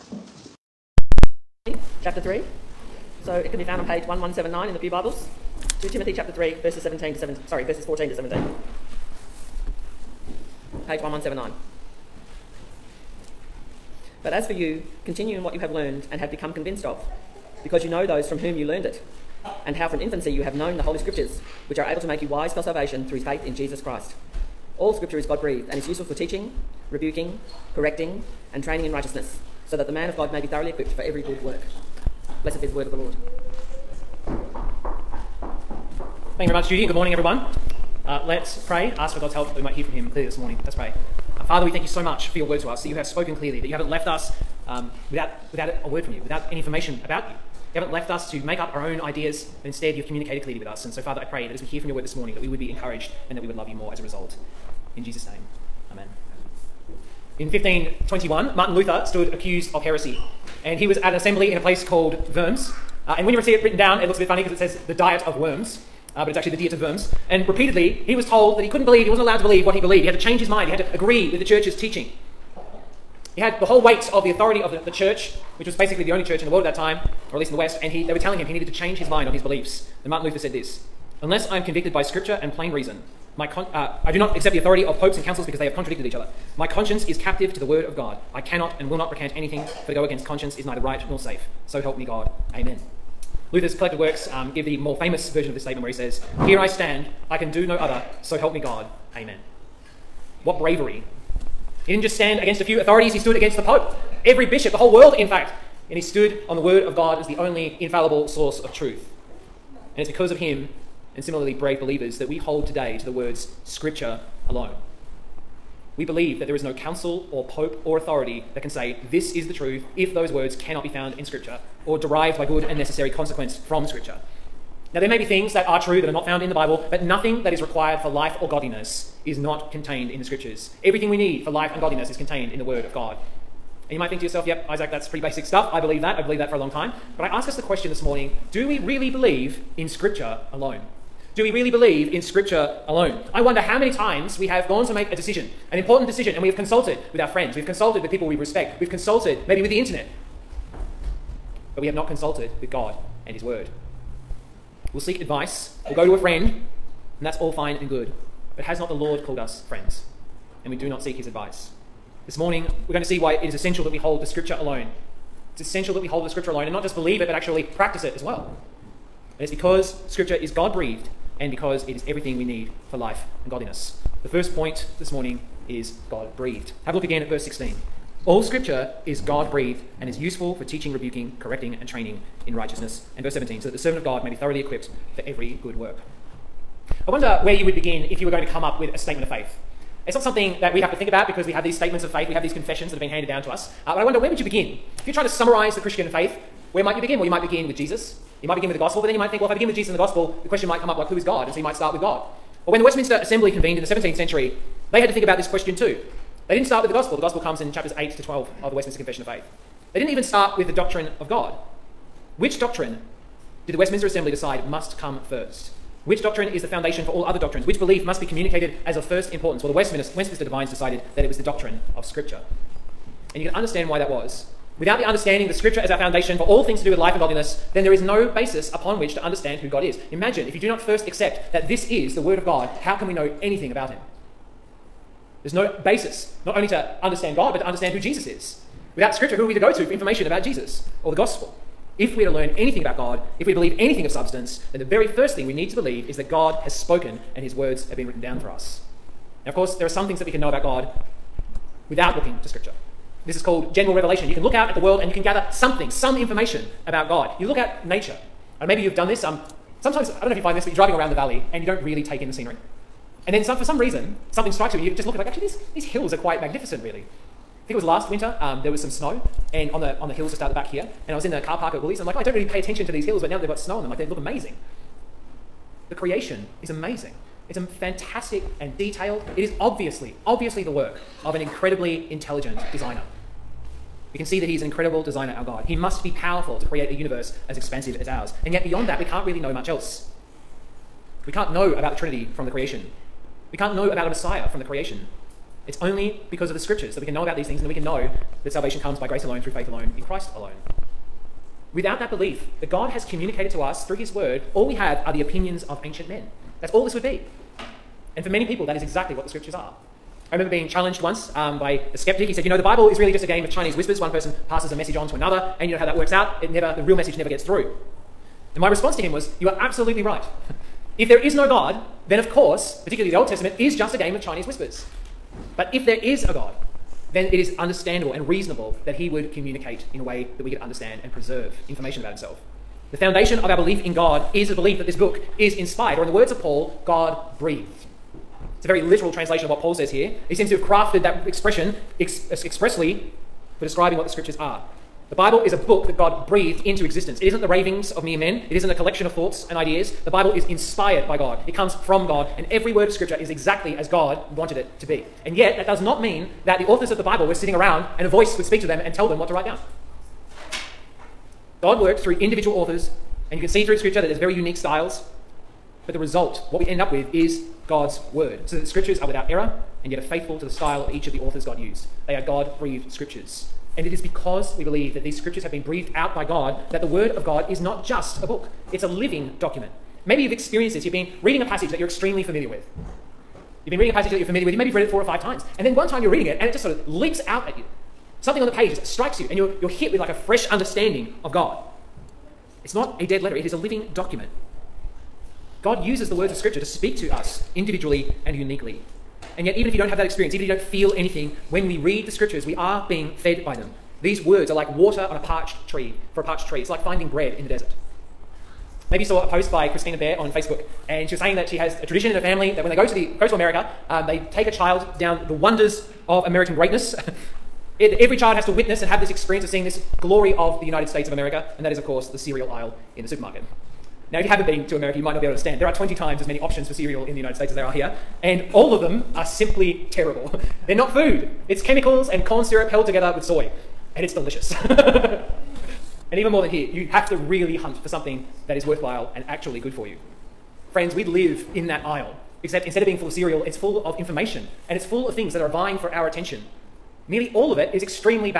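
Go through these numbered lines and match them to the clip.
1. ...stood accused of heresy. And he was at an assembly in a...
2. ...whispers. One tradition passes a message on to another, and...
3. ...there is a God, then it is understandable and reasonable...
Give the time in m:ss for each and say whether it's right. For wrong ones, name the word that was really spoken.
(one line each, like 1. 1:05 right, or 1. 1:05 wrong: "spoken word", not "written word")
1. 0:59 right
2. 5:13 wrong: "person", not "tradition"
3. 5:25 right.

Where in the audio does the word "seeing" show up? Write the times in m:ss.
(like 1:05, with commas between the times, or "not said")
6:59.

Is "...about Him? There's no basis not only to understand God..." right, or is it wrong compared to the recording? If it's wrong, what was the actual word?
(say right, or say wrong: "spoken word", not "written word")
right.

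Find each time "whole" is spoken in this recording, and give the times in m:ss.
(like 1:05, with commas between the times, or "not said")
1:13, 1:44.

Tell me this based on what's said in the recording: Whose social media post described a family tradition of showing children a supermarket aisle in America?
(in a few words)
Christina Bear.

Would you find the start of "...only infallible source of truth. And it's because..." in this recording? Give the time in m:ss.
1:47.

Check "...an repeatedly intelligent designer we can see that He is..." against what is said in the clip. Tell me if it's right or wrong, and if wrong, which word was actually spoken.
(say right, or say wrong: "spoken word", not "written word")
wrong: "incredibly", not "repeatedly".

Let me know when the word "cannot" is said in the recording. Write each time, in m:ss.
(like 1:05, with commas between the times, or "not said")
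1:28, 2:00.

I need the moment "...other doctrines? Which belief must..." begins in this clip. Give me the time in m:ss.
3:37.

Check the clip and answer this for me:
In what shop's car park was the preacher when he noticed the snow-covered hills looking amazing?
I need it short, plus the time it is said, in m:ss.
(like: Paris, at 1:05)
Woolies, at 4:31.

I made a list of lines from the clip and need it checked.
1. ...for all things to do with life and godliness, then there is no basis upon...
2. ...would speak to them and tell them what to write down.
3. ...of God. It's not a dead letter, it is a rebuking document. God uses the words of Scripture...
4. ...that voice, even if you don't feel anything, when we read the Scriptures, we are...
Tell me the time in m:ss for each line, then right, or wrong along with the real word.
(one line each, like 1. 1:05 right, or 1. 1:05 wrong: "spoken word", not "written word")
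1. 3:46 right
2. 5:58 right
3. 6:31 wrong: "living", not "rebuking"
4. 6:39 wrong: "experience", not "voice".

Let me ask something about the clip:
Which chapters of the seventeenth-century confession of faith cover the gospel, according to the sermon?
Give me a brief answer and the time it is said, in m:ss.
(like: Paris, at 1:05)
8 to 12, at 3:27.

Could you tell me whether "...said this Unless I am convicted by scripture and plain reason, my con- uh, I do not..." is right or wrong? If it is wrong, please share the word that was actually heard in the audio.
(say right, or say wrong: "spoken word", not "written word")
right.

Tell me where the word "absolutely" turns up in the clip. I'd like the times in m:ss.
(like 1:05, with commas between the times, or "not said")
5:19.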